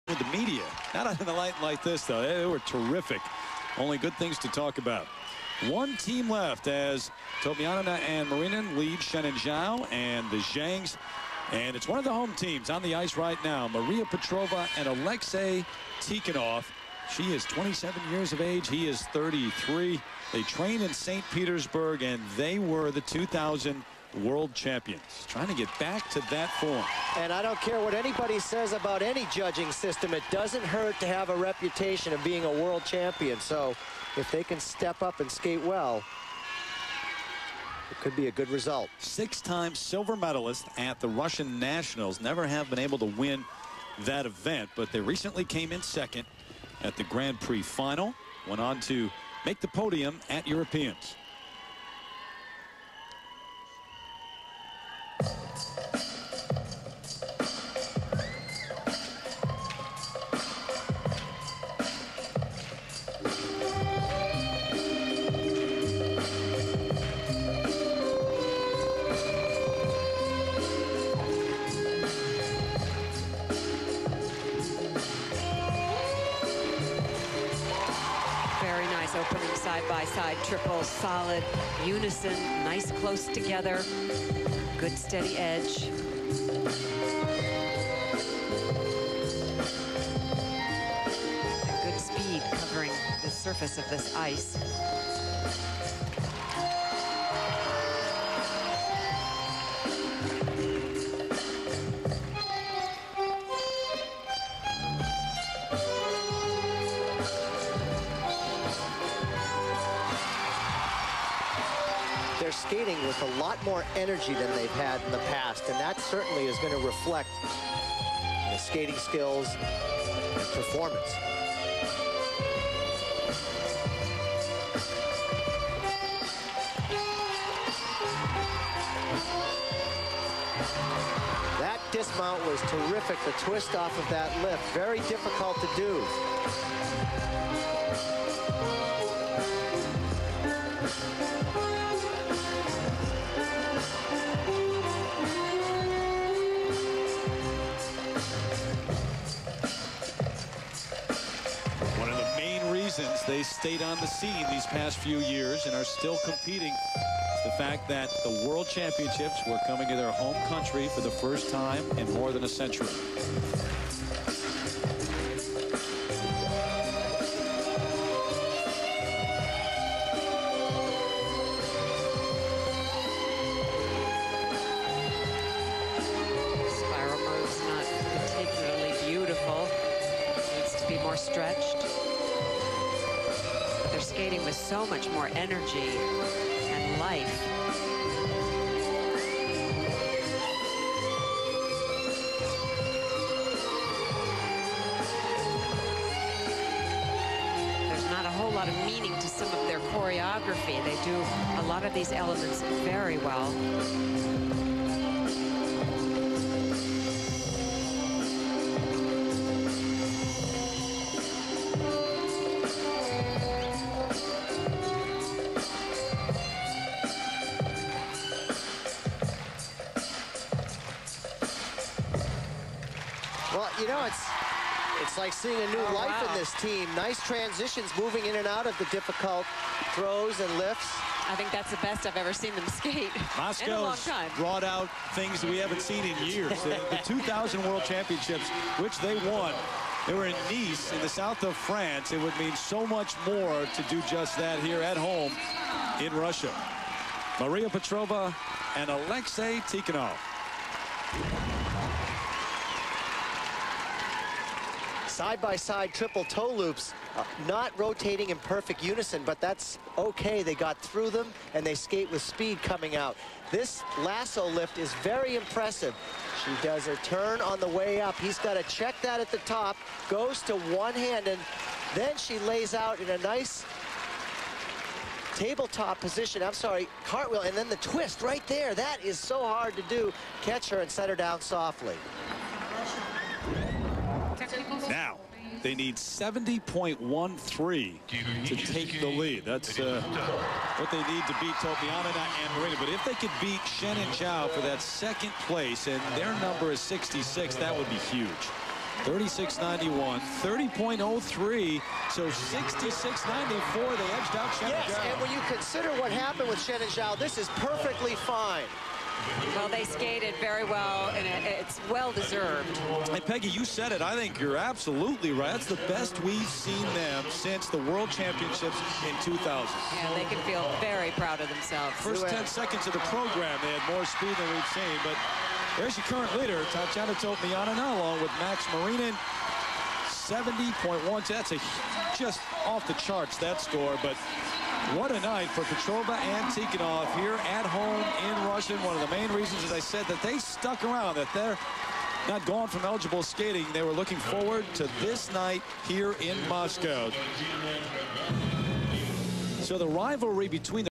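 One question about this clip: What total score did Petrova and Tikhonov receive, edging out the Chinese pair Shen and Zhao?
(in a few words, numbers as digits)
66.94.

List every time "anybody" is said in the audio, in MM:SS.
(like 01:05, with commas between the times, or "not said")
00:27.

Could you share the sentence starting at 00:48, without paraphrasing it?
Went on to make the podium at Europeans.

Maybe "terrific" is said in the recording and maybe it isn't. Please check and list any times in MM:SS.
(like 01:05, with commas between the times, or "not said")
00:02, 02:12.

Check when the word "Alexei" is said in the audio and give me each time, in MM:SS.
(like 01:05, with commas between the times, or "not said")
00:14, 04:08.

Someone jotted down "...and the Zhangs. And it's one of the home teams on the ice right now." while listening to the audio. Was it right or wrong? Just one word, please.
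right.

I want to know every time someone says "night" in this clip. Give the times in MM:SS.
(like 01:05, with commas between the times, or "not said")
05:35, 05:45.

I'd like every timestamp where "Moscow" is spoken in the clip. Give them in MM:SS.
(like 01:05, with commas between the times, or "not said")
03:53, 05:46.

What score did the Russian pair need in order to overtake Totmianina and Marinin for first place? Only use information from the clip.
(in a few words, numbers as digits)
70.13.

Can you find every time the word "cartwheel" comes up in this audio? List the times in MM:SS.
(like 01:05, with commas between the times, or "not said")
04:37.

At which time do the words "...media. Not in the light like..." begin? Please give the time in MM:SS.
00:00.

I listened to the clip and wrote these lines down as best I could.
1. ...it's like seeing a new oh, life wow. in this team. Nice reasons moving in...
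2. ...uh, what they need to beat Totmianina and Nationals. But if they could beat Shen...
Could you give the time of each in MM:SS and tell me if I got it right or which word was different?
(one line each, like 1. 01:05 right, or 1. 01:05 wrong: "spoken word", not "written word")
1. 03:45 wrong: "transitions", not "reasons"
2. 04:49 wrong: "Marinin", not "Nationals".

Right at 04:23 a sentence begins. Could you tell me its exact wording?
This lasso lift is very impressive.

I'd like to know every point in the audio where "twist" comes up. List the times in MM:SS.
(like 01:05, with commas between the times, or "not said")
02:13, 04:37.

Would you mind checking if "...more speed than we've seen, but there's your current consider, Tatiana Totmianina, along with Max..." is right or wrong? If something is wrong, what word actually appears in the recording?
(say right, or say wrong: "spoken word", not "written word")
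wrong: "leader", not "consider".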